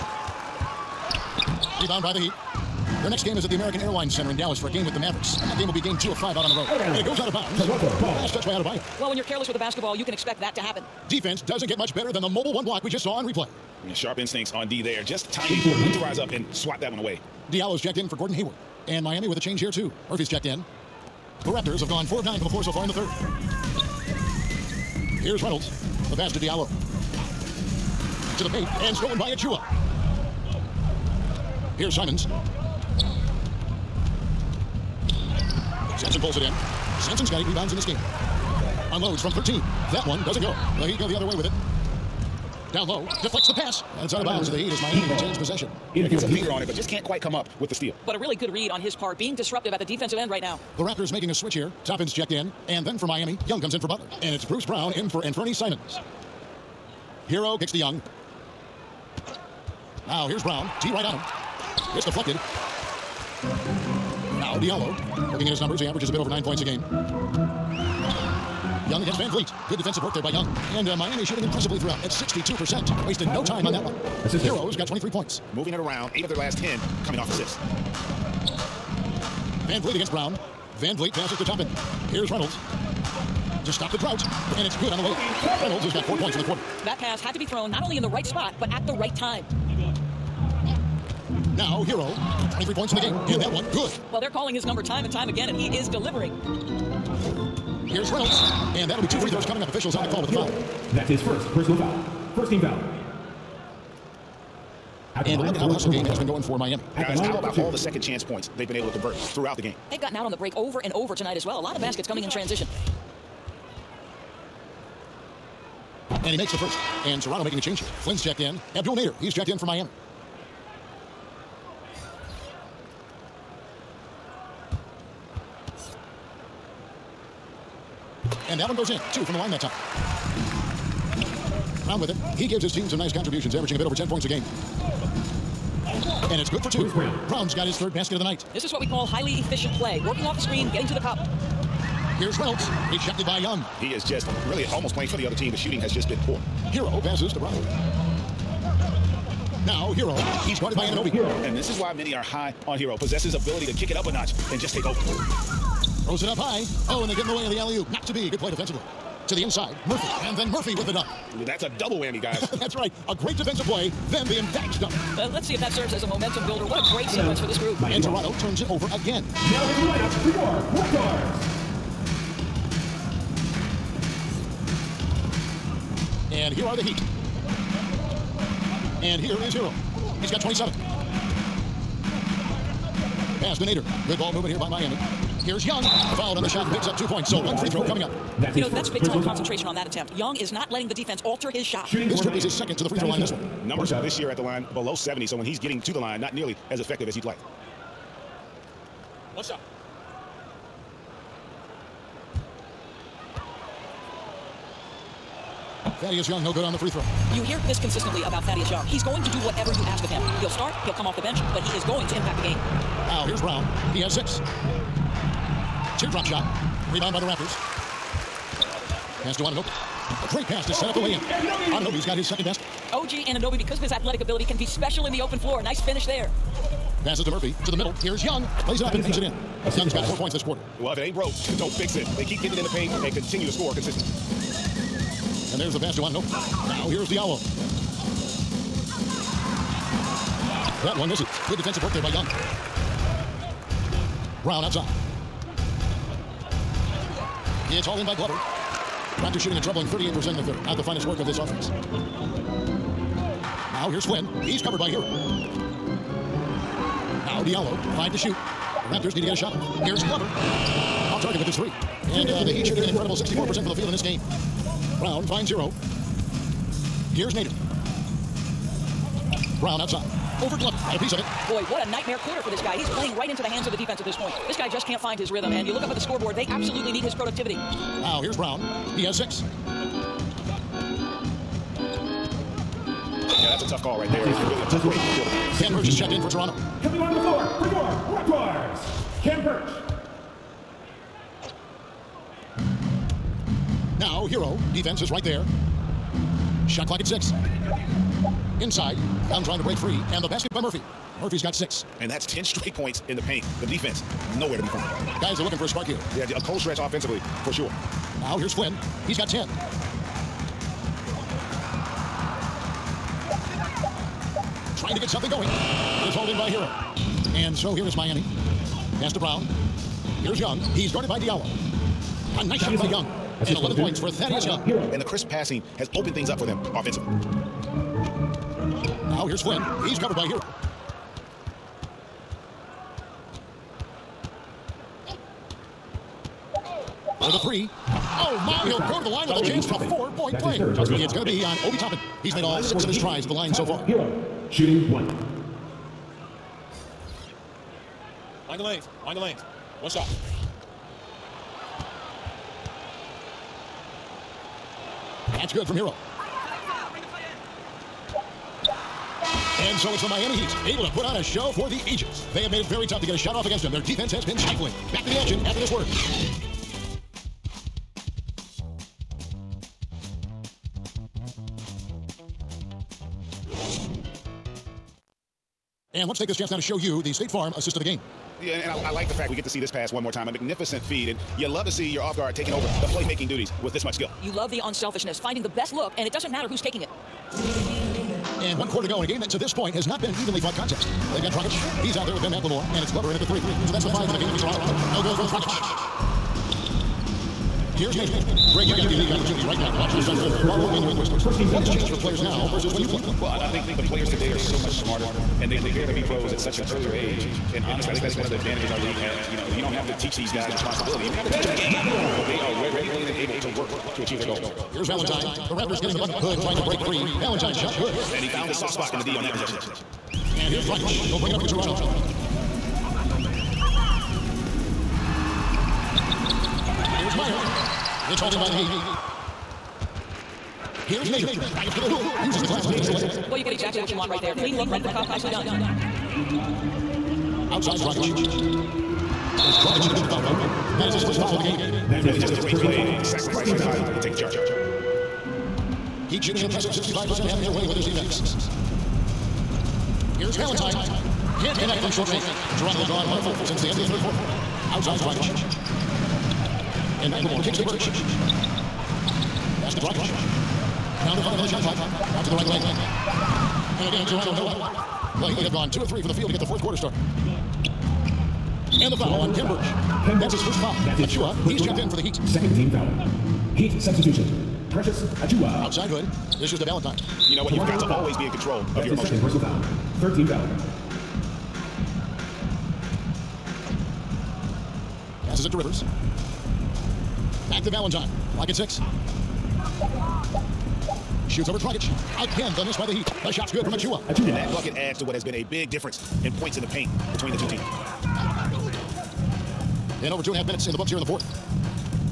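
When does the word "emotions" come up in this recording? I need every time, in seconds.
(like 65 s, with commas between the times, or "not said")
478 s.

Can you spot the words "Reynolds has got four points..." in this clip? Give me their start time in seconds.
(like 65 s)
85 s.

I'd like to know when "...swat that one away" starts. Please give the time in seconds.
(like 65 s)
16 s.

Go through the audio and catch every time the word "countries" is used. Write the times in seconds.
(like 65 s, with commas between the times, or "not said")
not said.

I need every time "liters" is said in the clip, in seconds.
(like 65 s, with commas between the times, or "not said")
not said.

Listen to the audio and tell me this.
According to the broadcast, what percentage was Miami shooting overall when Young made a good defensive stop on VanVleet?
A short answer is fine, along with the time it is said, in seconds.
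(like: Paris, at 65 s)
62%, at 72 s.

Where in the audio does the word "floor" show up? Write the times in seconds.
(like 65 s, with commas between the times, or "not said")
22 s, 225 s, 287 s.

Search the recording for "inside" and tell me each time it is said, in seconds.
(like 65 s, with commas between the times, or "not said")
159 s, 298 s.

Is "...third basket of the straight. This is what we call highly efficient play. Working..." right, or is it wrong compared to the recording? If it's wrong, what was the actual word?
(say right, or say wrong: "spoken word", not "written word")
wrong: "night", not "straight".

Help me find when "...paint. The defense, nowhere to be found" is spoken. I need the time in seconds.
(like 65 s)
303 s.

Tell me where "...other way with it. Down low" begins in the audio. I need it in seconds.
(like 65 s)
41 s.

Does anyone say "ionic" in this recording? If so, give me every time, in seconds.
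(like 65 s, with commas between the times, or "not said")
not said.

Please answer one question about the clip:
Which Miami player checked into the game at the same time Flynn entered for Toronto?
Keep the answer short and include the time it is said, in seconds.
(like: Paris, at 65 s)
Abdel Nader, at 118 s.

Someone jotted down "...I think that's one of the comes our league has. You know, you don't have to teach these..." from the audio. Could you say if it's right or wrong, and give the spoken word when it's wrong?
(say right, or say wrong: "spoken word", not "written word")
wrong: "advantages", not "comes".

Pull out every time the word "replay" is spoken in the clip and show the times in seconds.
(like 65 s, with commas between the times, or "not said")
13 s.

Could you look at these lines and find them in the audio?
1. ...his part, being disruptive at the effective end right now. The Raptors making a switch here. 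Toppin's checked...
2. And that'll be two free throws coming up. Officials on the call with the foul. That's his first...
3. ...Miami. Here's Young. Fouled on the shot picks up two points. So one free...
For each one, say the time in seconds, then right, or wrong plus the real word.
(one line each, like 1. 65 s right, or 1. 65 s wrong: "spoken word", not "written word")
1. 48 s wrong: "defensive", not "effective"
2. 98 s right
3. 184 s right.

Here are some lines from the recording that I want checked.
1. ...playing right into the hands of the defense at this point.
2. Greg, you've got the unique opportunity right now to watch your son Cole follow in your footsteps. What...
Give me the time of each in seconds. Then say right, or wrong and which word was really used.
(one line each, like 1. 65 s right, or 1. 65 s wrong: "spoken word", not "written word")
1. 272 s right
2. 398 s right.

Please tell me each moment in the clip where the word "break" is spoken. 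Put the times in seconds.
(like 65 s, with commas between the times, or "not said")
110 s, 284 s, 299 s, 416 s.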